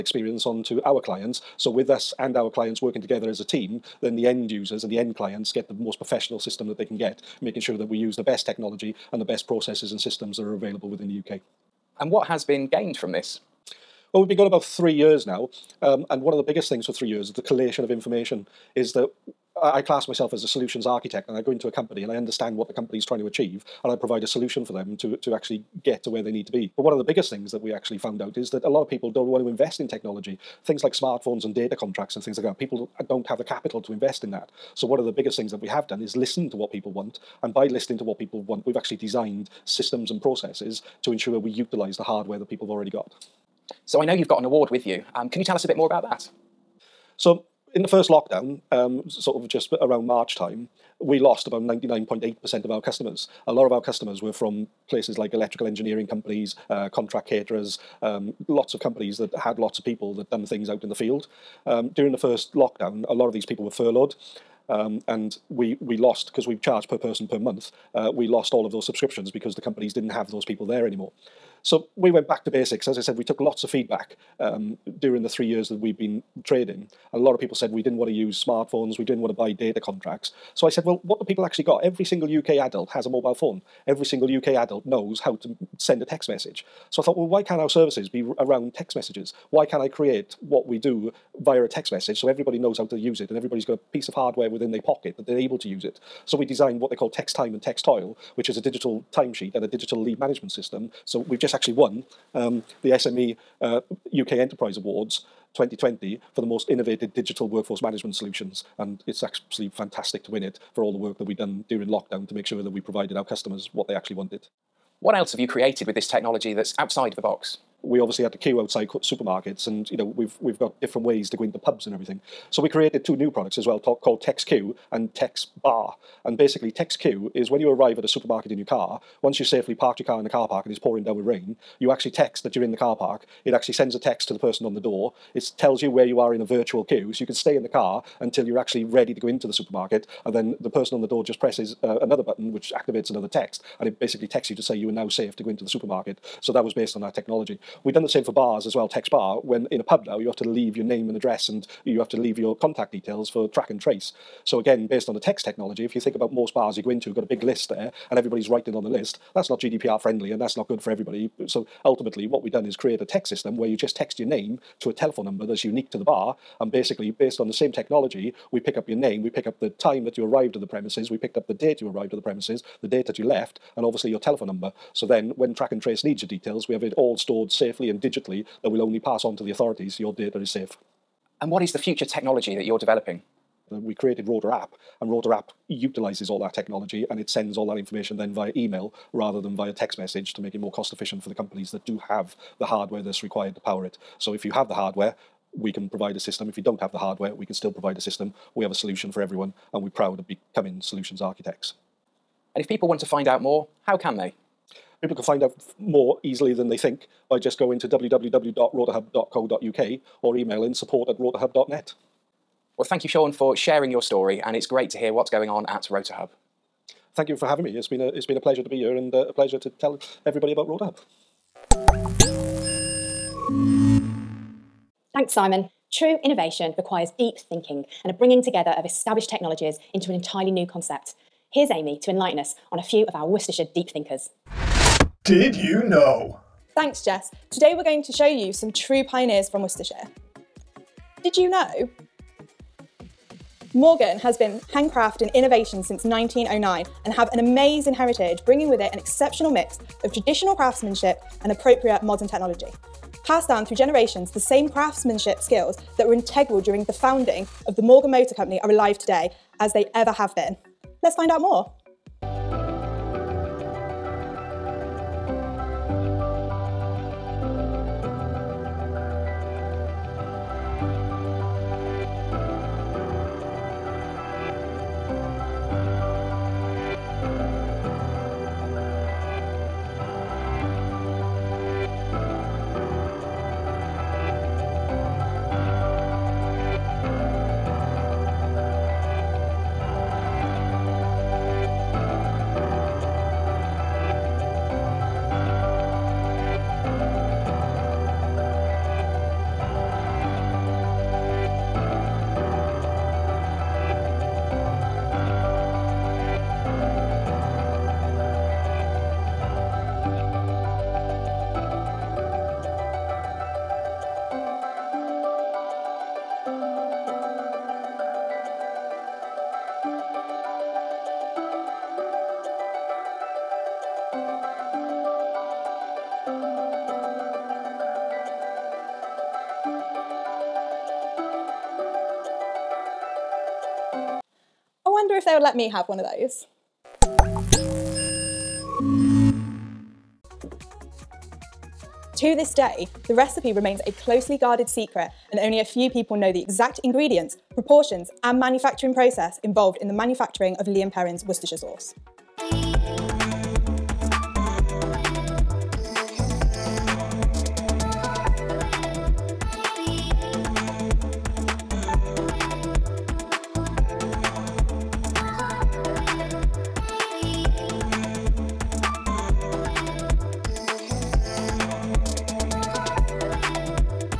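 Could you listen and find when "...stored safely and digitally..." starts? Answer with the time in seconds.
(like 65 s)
177 s.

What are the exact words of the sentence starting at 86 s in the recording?
So I thought, well, why can't our services be around text messages?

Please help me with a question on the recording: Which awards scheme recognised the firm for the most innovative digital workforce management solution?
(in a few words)
SME UK Enterprise Awards 2020.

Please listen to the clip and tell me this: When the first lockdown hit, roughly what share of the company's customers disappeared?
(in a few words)
99.8%.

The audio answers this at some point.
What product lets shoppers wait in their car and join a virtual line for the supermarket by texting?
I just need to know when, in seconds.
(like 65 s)
124 s.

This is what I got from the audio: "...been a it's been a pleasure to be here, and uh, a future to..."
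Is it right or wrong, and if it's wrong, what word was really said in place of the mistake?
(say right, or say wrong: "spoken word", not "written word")
wrong: "pleasure", not "future".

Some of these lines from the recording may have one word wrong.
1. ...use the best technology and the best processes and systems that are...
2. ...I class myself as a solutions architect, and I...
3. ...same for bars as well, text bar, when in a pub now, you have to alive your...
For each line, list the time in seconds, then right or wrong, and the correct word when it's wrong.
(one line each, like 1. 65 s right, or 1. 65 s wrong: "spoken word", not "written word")
1. 7 s right
2. 19 s right
3. 148 s wrong: "leave", not "alive".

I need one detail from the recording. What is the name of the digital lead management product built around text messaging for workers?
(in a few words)
Text Toil.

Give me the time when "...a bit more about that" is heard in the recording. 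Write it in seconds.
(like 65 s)
45 s.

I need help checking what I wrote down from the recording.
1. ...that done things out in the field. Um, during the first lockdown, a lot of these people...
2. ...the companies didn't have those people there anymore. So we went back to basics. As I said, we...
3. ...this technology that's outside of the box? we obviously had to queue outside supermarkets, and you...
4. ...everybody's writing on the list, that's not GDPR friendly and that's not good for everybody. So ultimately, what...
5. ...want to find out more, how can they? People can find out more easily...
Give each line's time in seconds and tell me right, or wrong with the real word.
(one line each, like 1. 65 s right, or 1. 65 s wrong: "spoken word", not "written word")
1. 60 s right
2. 69 s right
3. 115 s right
4. 158 s right
5. 202 s right.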